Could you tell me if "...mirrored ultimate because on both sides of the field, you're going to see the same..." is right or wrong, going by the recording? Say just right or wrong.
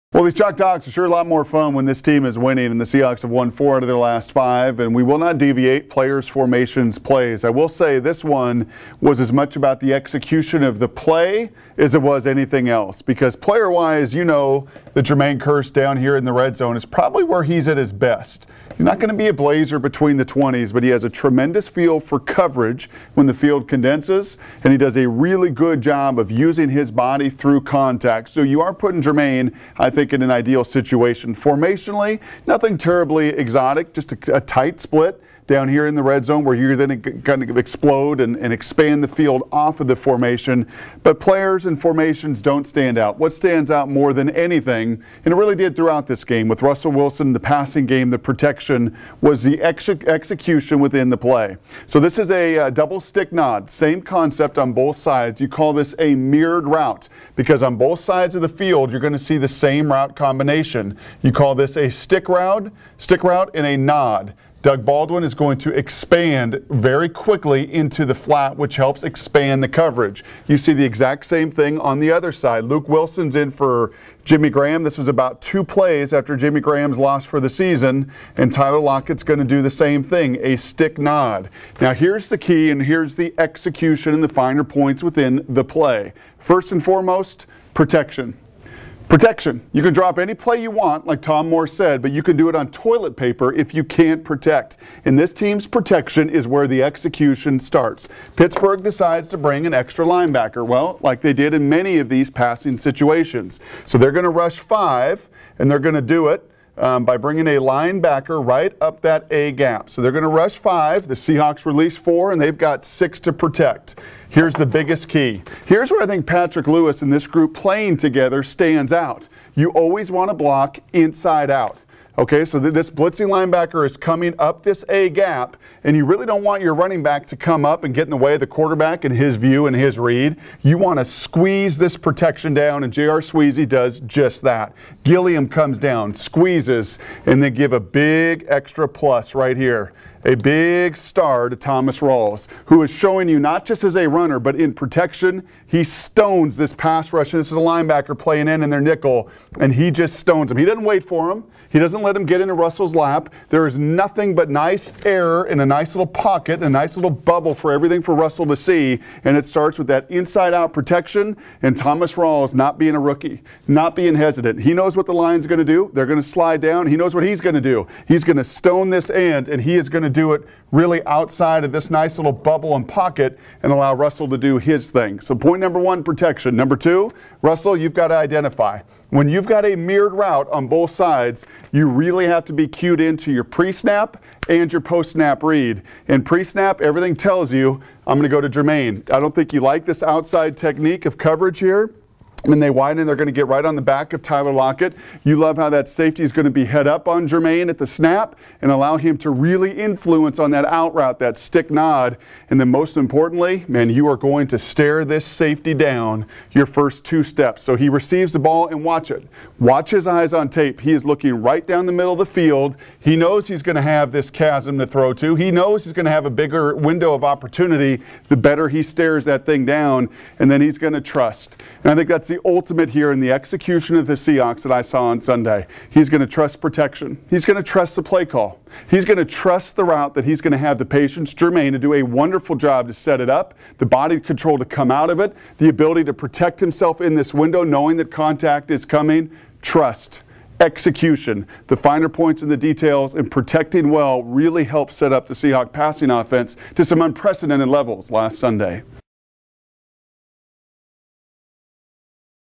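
wrong.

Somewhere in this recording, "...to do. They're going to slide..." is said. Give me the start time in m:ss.
2:45.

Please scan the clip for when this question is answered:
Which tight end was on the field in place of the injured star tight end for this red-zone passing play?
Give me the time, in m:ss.
1:12.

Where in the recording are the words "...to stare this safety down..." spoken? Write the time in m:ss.
3:24.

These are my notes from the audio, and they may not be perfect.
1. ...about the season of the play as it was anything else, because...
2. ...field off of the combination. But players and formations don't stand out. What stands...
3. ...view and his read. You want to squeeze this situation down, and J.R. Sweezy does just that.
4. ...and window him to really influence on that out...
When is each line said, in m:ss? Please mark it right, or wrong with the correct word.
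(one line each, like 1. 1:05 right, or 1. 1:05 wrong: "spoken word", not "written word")
1. 0:09 wrong: "execution", not "season"
2. 0:39 wrong: "formation", not "combination"
3. 2:09 wrong: "protection", not "situation"
4. 3:18 wrong: "allow", not "window".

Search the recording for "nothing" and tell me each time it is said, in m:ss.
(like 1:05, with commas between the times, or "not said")
0:32, 2:33.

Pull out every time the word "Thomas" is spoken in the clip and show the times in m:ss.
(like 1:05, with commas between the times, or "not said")
2:21, 2:41.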